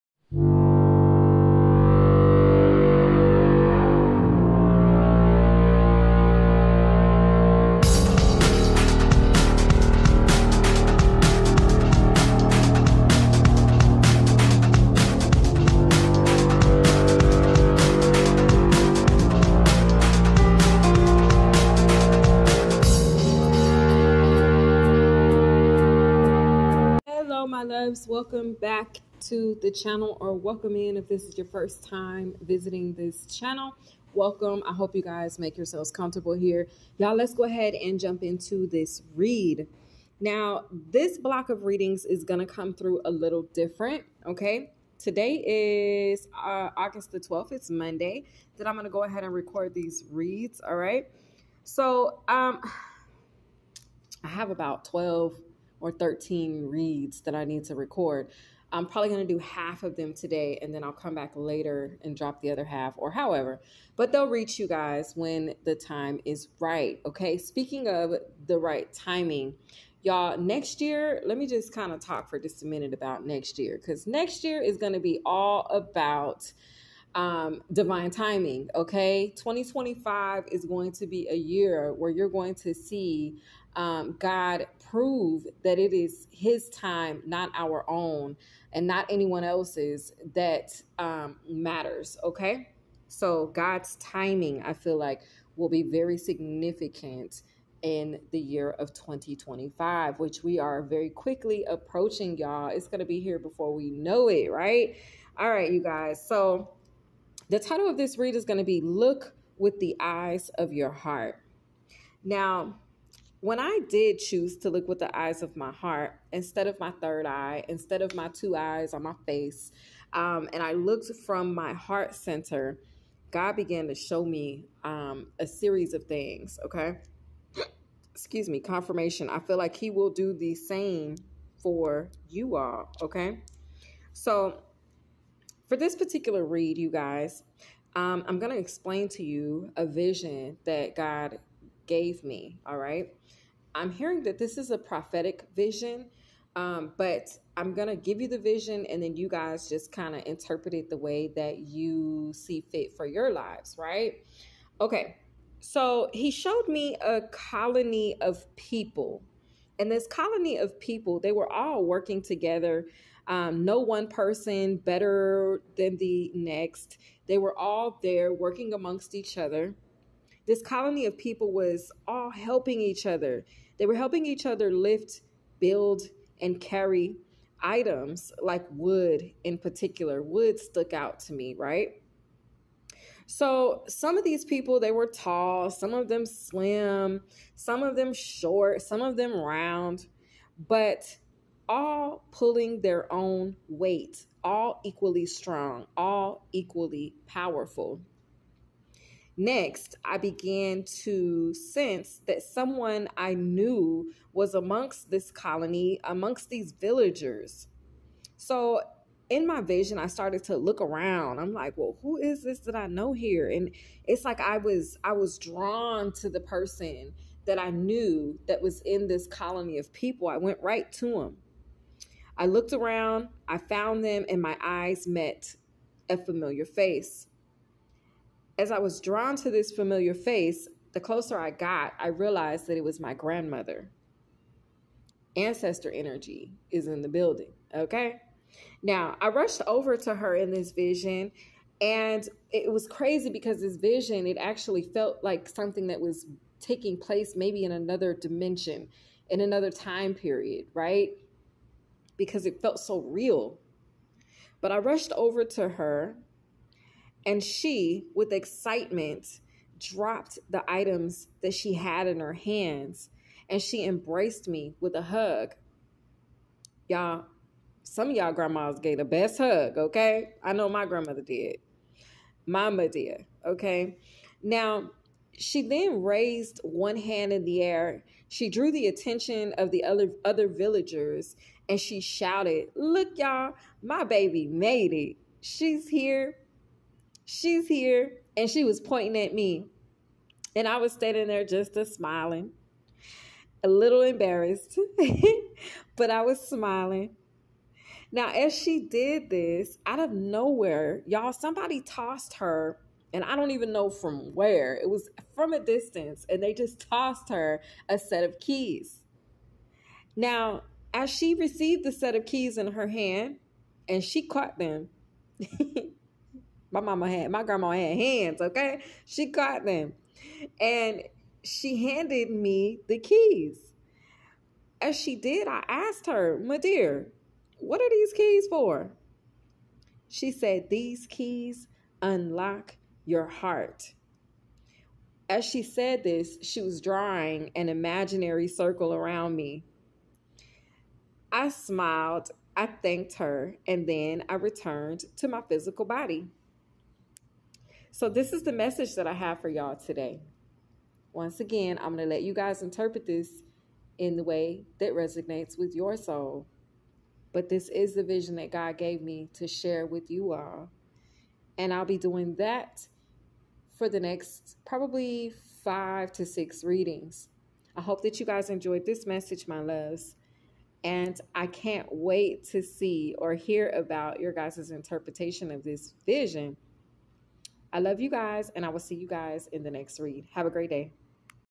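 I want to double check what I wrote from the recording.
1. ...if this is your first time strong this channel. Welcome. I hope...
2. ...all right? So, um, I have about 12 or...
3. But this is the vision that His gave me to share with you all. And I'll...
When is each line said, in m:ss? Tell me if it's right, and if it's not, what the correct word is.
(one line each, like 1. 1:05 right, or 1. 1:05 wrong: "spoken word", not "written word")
1. 0:30 wrong: "visiting", not "strong"
2. 0:50 right
3. 5:57 wrong: "God", not "His".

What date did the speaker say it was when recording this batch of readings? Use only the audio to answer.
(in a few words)
August 12.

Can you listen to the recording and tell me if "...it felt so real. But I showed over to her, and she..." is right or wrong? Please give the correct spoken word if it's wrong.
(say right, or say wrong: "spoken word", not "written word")
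wrong: "rushed", not "showed".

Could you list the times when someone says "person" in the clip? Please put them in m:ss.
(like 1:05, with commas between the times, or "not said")
2:44, 3:36.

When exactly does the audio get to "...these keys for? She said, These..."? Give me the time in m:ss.
5:27.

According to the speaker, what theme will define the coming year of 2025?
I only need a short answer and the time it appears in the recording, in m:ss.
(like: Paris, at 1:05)
divine timing, at 1:17.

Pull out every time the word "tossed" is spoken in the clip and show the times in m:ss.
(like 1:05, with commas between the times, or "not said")
5:01, 5:06.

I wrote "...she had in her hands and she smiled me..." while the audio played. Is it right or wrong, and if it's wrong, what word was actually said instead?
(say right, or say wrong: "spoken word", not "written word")
wrong: "embraced", not "smiled".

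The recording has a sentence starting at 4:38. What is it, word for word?
She drew the attention of the other, other villagers and she shouted, Look, y'all, my baby made it.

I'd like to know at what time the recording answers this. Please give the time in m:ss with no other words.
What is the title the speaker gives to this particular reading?
1:48.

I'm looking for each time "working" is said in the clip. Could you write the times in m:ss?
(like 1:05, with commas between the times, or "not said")
2:41, 2:48.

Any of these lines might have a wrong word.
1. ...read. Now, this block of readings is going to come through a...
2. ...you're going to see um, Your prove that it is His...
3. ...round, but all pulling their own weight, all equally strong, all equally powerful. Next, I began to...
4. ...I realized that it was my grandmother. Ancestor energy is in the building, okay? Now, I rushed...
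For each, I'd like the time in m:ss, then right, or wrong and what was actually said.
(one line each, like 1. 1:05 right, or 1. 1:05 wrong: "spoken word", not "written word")
1. 0:39 right
2. 1:22 wrong: "God", not "Your"
3. 3:09 right
4. 3:51 right.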